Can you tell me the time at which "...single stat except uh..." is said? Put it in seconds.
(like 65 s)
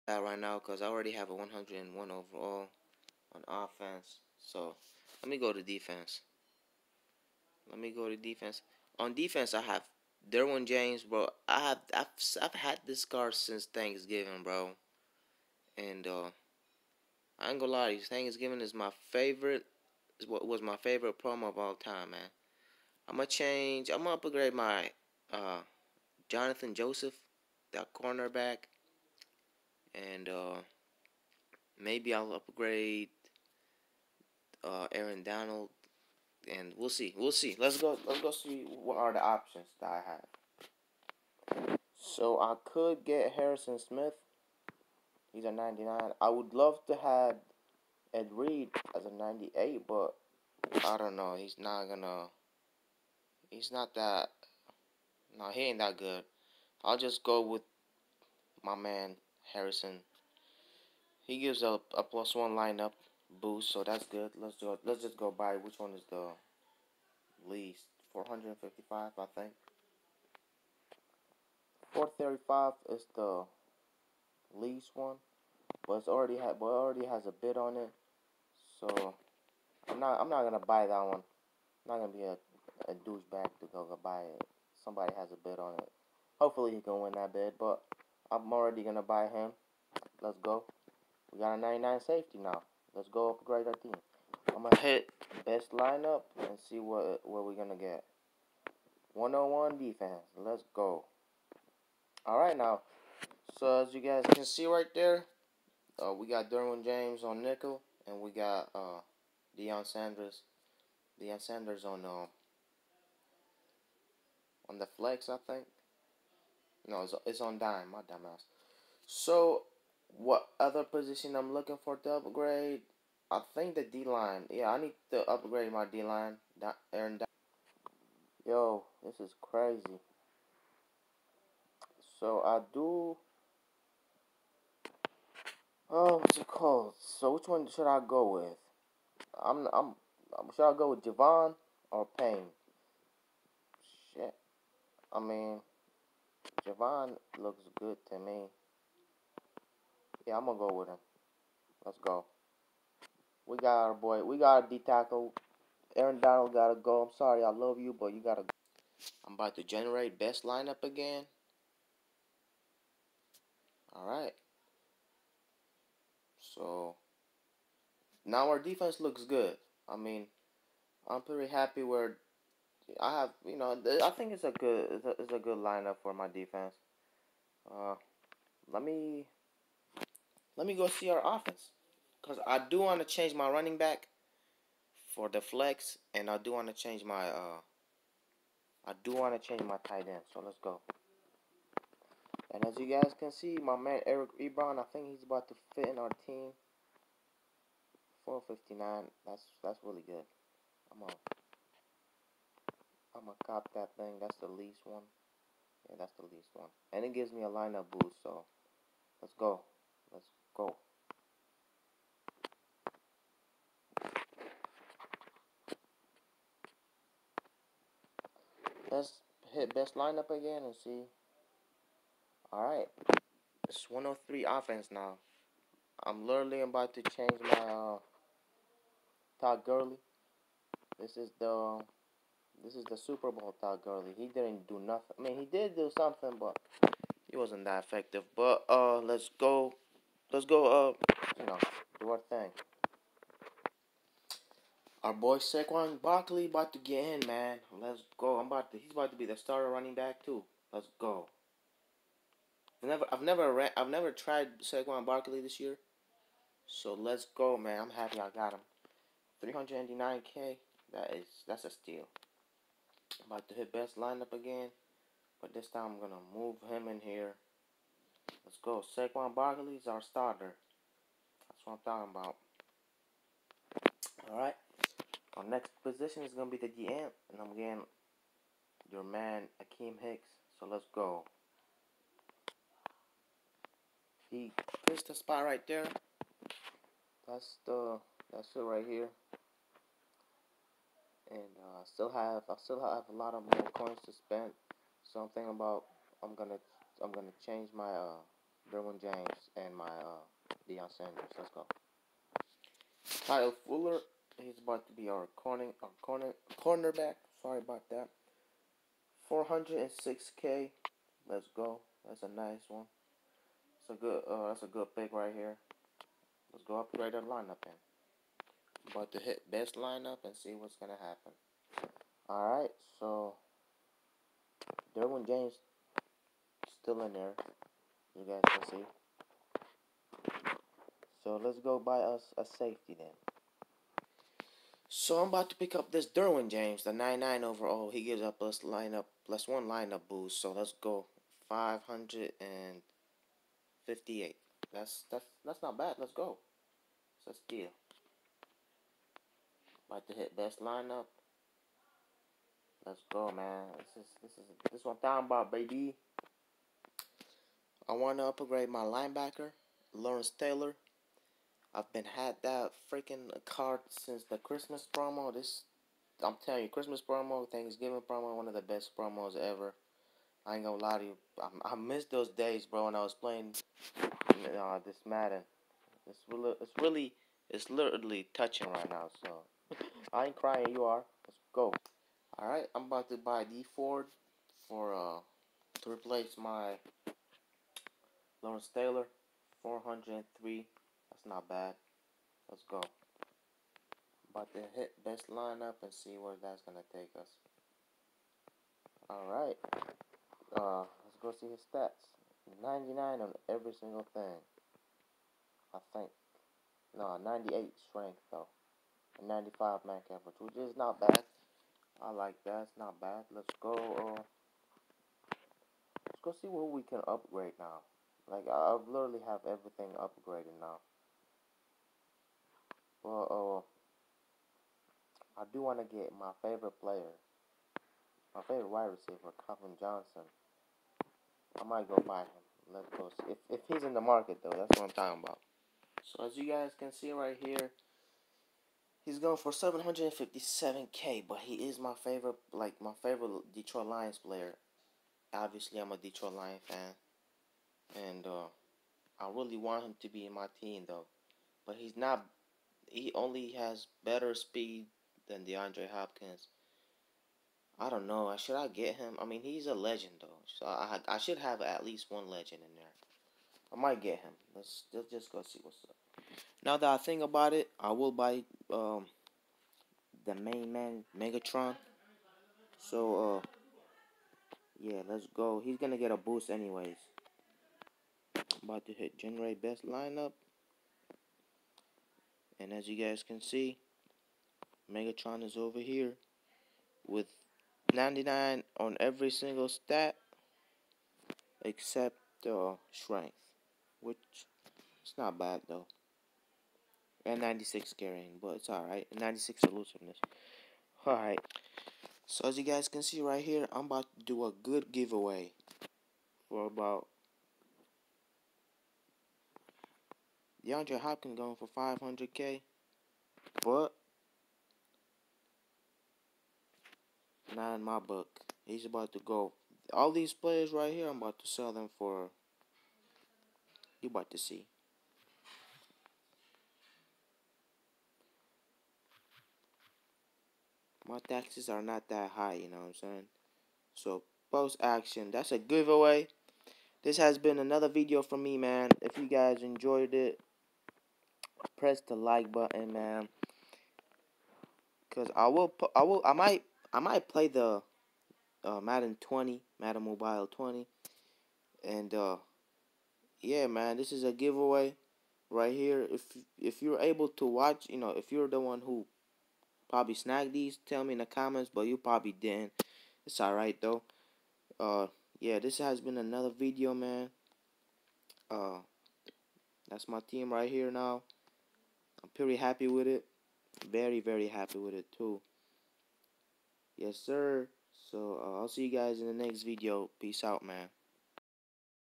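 489 s.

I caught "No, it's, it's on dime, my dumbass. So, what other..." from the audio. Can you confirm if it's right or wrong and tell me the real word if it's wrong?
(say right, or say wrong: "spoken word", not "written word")
right.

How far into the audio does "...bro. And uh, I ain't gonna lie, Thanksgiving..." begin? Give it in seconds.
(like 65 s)
14 s.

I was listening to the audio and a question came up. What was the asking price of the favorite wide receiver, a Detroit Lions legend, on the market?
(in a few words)
757k.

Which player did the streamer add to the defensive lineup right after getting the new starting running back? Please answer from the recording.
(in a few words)
Akiem Hicks.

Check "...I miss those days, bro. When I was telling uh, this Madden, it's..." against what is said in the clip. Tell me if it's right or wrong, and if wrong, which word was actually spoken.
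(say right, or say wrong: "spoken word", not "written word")
wrong: "playing", not "telling".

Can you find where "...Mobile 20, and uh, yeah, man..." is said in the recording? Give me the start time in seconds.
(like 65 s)
550 s.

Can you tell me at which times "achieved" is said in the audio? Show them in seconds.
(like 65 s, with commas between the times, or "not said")
not said.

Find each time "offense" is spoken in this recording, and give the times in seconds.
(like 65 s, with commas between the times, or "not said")
3 s, 181 s, 224 s.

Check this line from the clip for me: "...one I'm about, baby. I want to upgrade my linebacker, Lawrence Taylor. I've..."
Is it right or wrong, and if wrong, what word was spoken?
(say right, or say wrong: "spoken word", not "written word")
right.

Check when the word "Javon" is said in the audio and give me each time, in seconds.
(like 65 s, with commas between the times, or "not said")
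141 s, 146 s.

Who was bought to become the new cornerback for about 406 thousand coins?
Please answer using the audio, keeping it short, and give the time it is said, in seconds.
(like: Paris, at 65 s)
Kyle Fuller, at 303 s.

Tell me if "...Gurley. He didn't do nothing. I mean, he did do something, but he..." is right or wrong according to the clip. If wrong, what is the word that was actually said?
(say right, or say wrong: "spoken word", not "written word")
right.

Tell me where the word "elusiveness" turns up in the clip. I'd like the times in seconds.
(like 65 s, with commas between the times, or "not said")
499 s.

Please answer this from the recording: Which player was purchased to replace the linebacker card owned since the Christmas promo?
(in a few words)
Dee Ford.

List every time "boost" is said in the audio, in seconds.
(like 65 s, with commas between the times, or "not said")
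63 s, 207 s, 340 s, 476 s.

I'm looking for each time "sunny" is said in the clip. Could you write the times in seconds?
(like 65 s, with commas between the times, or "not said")
not said.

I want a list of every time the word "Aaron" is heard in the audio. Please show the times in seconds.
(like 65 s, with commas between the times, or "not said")
34 s, 126 s, 155 s.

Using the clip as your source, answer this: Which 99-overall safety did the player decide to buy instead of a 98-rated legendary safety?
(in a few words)
Harrison Smith.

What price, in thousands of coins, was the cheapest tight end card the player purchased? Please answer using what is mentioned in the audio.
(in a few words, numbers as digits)
459.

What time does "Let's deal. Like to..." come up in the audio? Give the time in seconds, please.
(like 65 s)
347 s.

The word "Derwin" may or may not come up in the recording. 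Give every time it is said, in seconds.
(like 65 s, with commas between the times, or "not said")
10 s, 106 s, 298 s, 324 s, 336 s.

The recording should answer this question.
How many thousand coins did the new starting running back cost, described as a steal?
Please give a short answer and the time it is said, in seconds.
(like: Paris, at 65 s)
399k, at 259 s.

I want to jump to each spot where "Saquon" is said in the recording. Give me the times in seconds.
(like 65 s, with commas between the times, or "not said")
245 s, 254 s, 268 s.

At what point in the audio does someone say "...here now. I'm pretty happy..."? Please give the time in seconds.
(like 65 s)
570 s.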